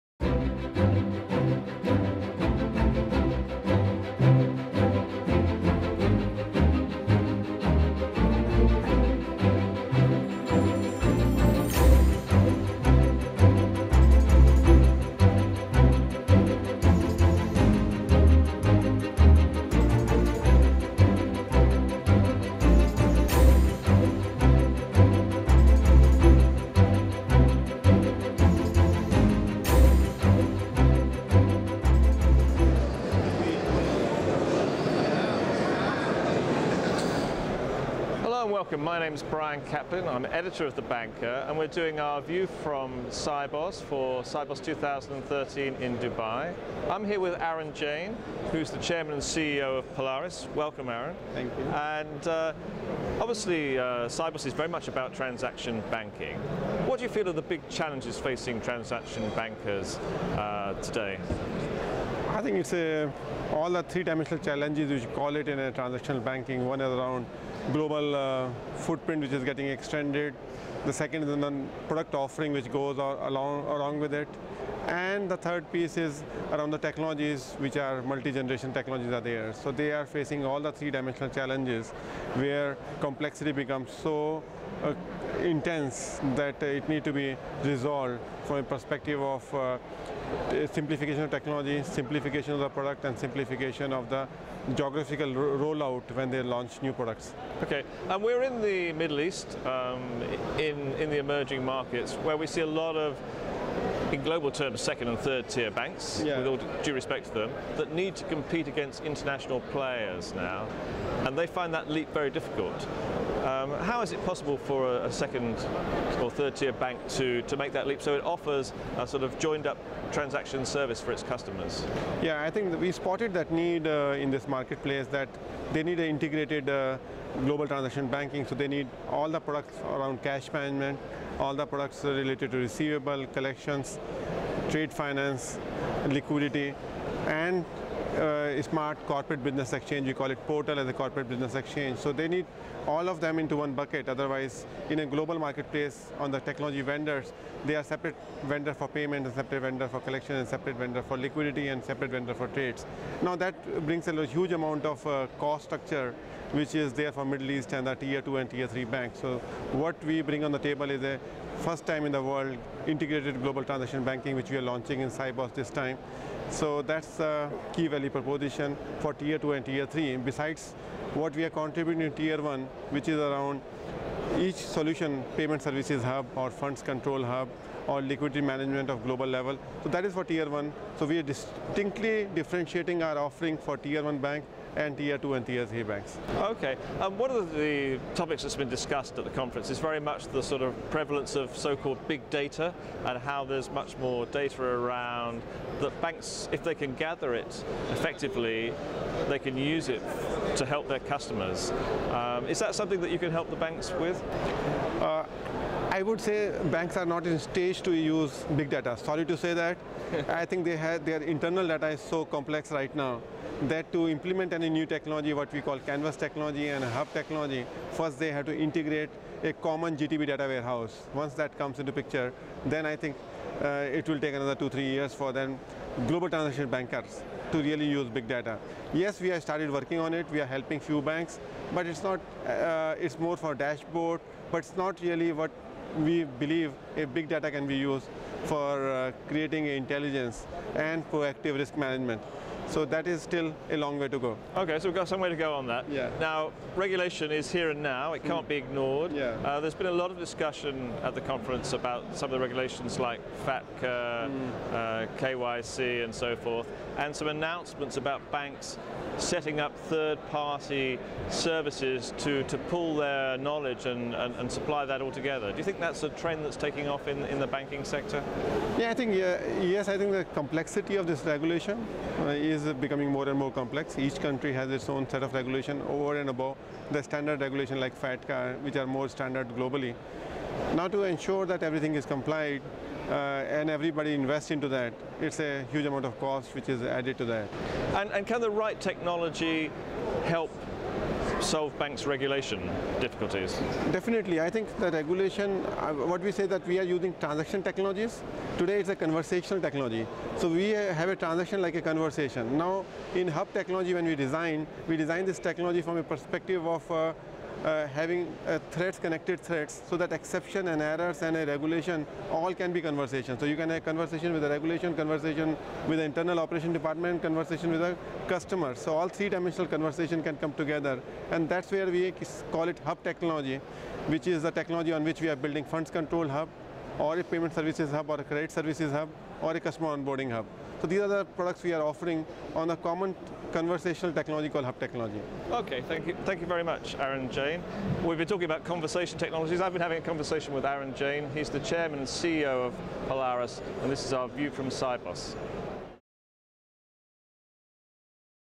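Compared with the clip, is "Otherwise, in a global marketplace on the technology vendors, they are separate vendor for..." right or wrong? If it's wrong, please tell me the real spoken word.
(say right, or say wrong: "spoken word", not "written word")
right.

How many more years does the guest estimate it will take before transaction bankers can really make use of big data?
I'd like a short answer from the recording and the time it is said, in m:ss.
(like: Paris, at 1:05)
2 to 3 years, at 3:44.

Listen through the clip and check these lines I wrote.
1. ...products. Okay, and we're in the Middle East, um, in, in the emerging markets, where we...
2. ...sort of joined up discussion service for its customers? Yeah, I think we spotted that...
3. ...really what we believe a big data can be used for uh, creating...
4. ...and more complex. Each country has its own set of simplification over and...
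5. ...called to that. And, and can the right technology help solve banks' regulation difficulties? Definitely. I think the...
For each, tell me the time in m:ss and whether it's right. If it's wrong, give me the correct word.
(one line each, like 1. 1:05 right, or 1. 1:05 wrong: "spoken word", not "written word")
1. 1:36 right
2. 1:59 wrong: "transaction", not "discussion"
3. 3:55 right
4. 4:33 wrong: "regulation", not "simplification"
5. 4:46 wrong: "added", not "called".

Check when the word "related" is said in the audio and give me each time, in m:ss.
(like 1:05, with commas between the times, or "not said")
2:12.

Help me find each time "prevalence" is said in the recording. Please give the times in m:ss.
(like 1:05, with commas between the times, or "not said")
3:10.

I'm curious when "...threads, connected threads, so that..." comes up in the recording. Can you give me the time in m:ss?
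5:08.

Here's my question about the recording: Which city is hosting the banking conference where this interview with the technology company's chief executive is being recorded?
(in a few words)
Dubai.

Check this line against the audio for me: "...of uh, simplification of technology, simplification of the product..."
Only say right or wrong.
right.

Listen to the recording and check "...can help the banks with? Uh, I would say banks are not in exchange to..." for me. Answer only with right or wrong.
wrong.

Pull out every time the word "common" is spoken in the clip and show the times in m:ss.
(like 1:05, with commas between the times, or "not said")
3:39, 5:32.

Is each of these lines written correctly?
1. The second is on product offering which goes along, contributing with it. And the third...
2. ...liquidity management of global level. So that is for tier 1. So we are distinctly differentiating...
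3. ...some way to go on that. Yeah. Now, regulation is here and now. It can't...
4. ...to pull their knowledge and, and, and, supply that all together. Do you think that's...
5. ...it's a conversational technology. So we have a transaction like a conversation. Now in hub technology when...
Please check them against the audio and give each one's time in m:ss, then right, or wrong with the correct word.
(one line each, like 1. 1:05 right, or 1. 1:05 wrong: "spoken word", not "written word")
1. 1:10 wrong: "along", not "contributing"
2. 2:58 right
3. 4:05 right
4. 4:22 right
5. 4:58 right.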